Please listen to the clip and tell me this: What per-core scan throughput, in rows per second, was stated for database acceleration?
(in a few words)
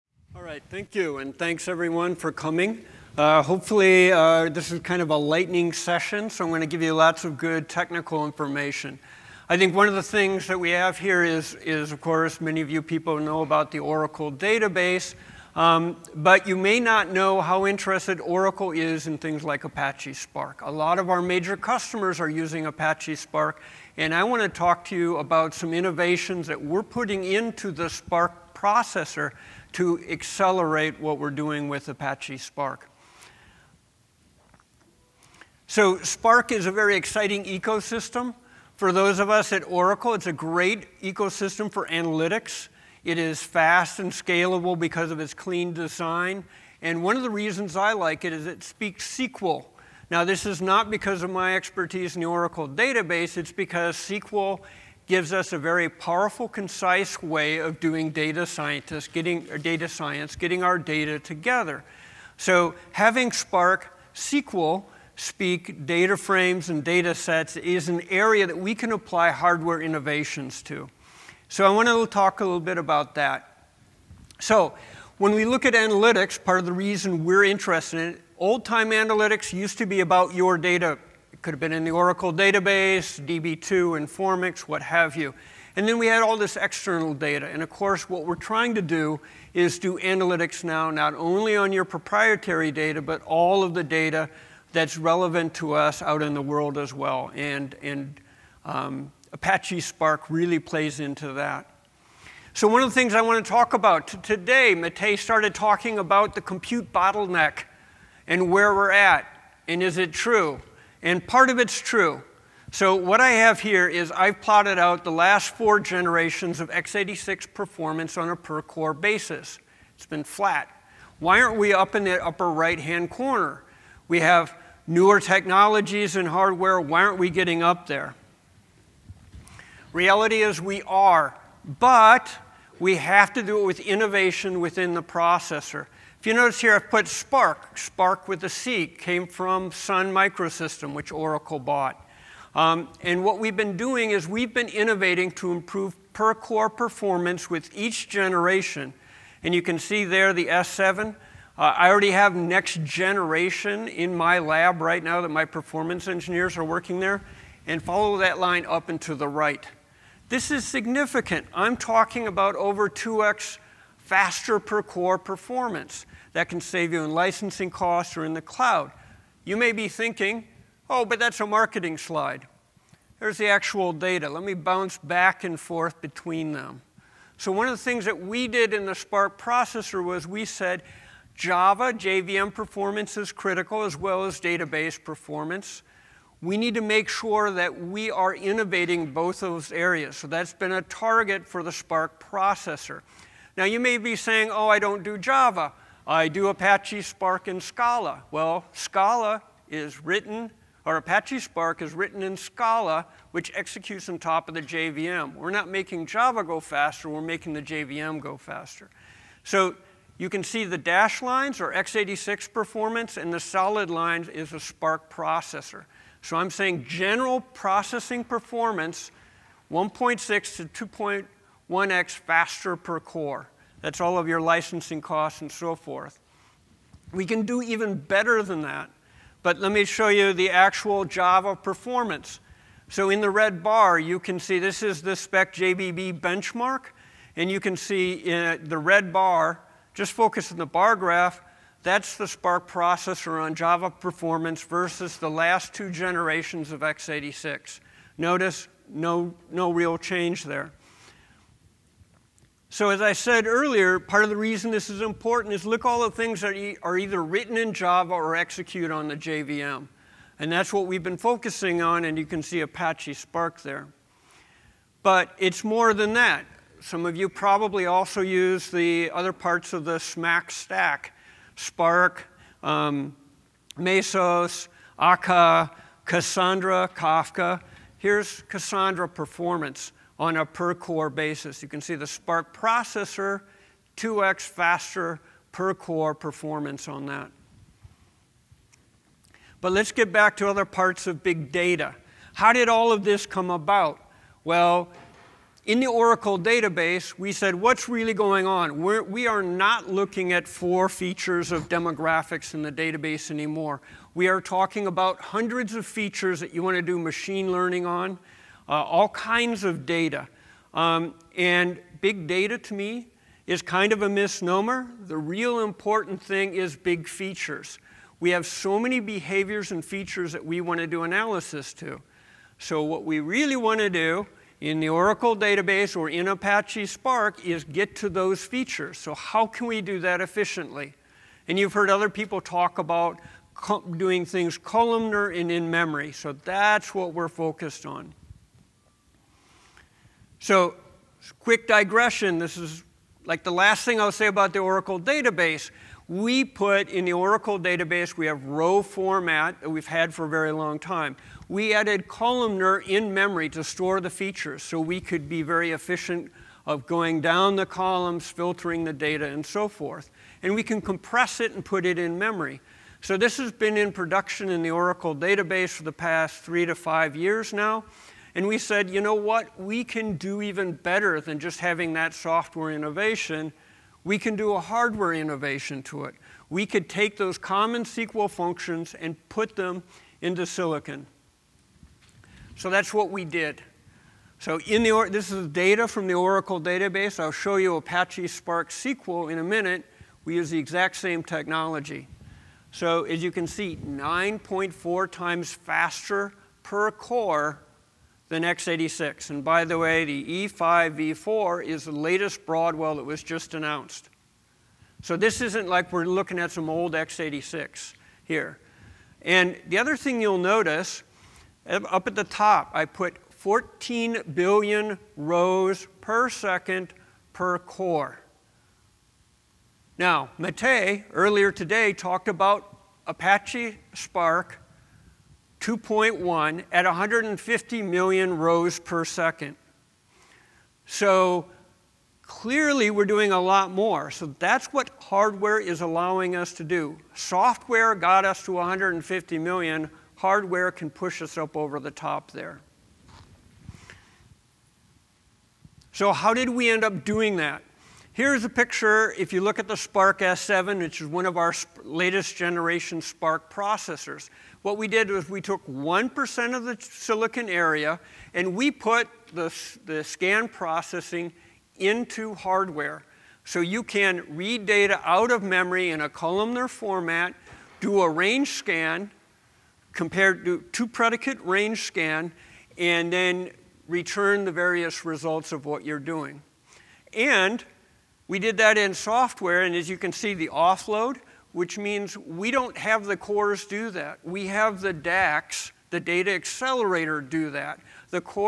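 14 billion.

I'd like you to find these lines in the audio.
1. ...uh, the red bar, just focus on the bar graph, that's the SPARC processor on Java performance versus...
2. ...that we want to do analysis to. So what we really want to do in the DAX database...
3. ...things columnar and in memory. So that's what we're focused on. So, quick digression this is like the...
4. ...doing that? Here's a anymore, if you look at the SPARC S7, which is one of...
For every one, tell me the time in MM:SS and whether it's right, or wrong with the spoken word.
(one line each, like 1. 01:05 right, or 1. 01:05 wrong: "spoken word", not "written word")
1. 03:58 right
2. 05:20 wrong: "Oracle", not "DAX"
3. 05:34 right
4. 07:27 wrong: "picture", not "anymore".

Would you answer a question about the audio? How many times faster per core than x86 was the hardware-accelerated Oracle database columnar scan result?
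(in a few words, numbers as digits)
9.4.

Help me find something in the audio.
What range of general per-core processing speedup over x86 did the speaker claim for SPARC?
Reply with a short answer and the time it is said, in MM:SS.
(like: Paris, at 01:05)
1.6 to 2.1x, at 03:39.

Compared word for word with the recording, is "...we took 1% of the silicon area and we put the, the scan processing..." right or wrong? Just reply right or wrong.
right.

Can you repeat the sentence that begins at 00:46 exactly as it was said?
And one of the reasons I like it is it speaks SQL.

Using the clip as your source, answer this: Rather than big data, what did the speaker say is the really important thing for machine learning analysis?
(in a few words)
big features.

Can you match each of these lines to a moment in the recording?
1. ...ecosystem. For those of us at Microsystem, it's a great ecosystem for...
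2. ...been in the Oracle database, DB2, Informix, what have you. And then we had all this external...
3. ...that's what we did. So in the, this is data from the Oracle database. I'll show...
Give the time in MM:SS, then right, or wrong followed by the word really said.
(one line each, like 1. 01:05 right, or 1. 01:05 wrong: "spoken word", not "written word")
1. 00:37 wrong: "Oracle", not "Microsystem"
2. 01:21 right
3. 06:22 right.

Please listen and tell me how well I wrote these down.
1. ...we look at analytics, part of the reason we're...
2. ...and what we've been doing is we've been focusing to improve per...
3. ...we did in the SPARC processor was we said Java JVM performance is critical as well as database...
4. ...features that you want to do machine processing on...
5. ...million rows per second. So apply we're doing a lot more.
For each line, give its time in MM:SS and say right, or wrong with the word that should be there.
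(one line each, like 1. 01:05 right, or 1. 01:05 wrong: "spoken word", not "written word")
1. 01:15 right
2. 02:23 wrong: "innovating", not "focusing"
3. 02:58 right
4. 05:05 wrong: "learning", not "processing"
5. 07:07 wrong: "clearly", not "apply".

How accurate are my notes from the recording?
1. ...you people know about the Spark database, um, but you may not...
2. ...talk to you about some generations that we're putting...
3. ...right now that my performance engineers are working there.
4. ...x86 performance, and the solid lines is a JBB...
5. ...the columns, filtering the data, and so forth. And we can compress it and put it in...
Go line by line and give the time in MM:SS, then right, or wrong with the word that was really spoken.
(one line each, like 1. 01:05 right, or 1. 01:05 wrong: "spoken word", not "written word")
1. 00:12 wrong: "Oracle", not "Spark"
2. 00:24 wrong: "innovations", not "generations"
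3. 02:34 right
4. 03:31 wrong: "SPARC", not "JBB"
5. 05:57 right.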